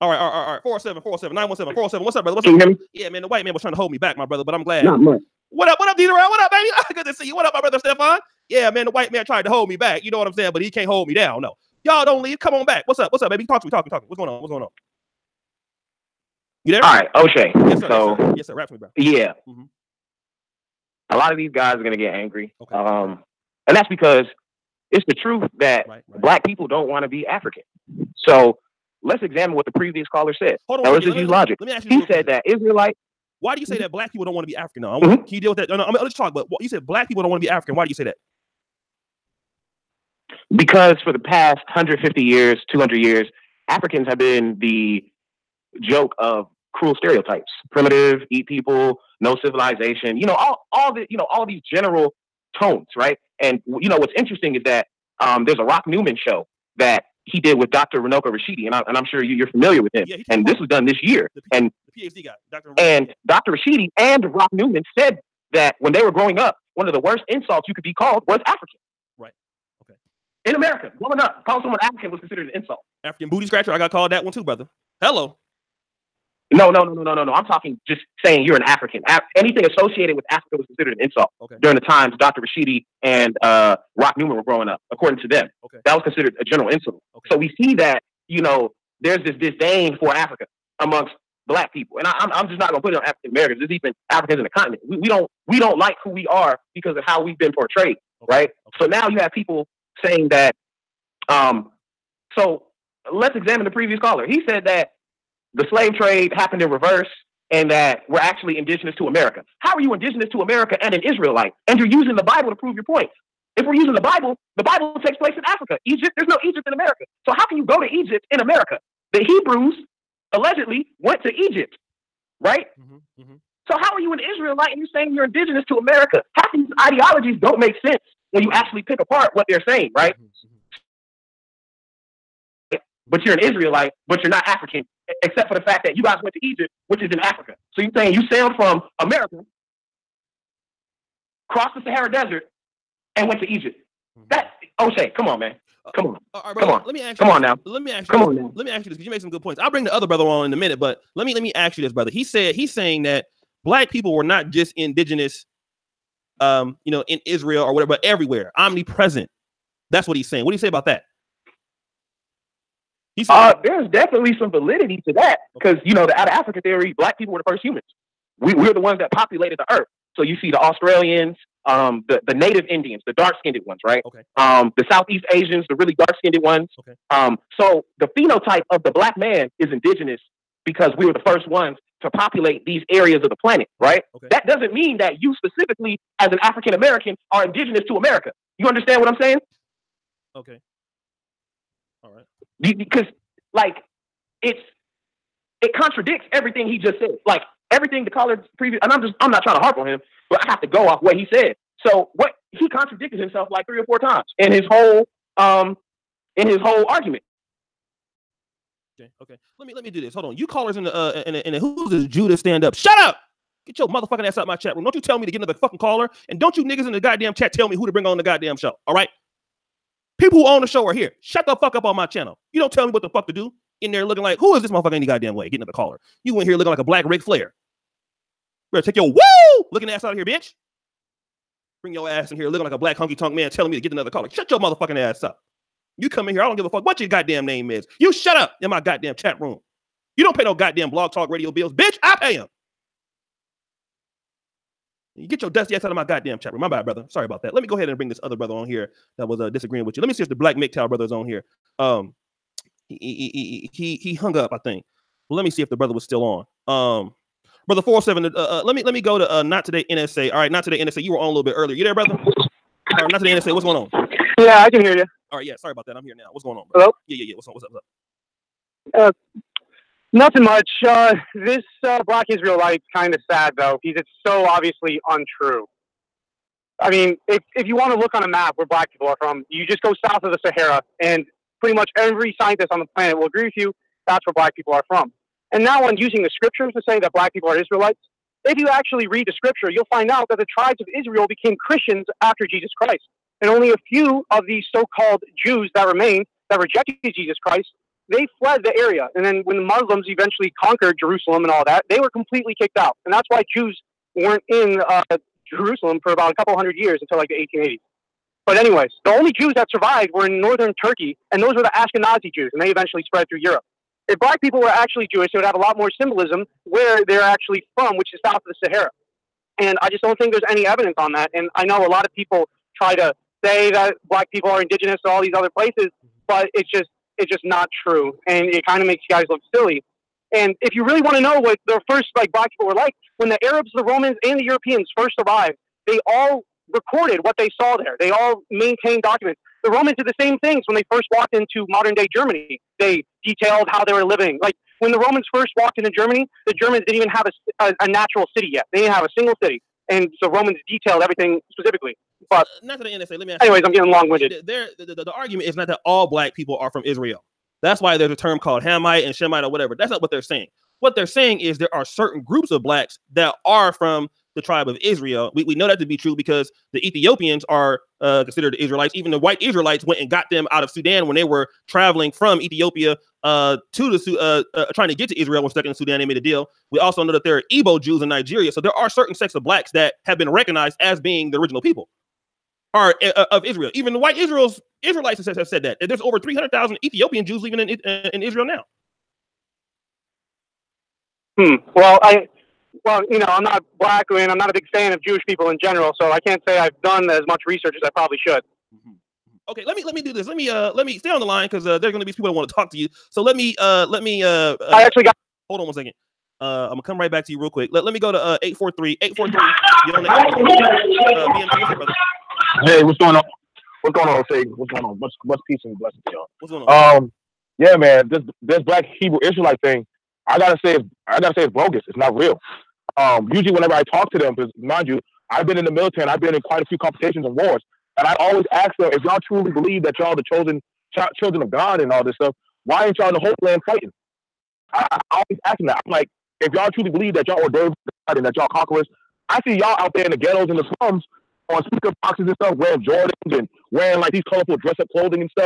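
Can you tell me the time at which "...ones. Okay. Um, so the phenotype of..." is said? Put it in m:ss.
2:56.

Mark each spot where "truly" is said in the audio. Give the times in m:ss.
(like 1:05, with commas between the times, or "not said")
7:09, 7:16.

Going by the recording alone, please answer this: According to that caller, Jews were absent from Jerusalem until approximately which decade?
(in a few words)
1880s.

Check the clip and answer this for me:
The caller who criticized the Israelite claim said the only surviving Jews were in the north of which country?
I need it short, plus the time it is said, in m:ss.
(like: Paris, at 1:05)
Turkey, at 5:10.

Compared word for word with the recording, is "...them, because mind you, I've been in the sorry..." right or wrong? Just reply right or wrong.
wrong.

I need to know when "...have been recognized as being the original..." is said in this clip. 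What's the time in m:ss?
6:20.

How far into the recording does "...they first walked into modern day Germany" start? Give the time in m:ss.
5:40.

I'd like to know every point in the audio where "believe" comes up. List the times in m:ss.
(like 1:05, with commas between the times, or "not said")
7:09, 7:16.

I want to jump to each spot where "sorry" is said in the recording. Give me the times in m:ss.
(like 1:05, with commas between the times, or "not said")
4:07, 4:25.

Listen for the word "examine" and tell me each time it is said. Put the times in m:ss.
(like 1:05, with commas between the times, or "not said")
0:29, 1:43.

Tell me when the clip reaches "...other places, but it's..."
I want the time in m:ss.
5:25.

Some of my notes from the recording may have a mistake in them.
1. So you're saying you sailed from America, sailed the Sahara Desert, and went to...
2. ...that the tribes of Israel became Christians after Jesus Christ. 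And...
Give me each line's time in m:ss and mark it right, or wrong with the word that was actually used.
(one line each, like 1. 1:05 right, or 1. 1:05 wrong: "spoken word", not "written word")
1. 2:17 wrong: "crossed", not "sailed"
2. 4:50 right.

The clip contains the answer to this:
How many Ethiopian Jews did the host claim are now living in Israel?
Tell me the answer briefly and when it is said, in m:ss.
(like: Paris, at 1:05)
over 300,000, at 6:26.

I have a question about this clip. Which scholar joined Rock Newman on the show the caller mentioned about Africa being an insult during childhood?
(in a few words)
Dr. Runoko Rashidi.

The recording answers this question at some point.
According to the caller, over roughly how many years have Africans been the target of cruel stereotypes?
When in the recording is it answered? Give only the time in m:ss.
0:41.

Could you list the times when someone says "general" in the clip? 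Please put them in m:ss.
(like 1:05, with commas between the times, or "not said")
0:51, 1:26, 6:35.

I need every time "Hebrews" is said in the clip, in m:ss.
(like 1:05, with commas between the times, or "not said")
1:59, 6:58.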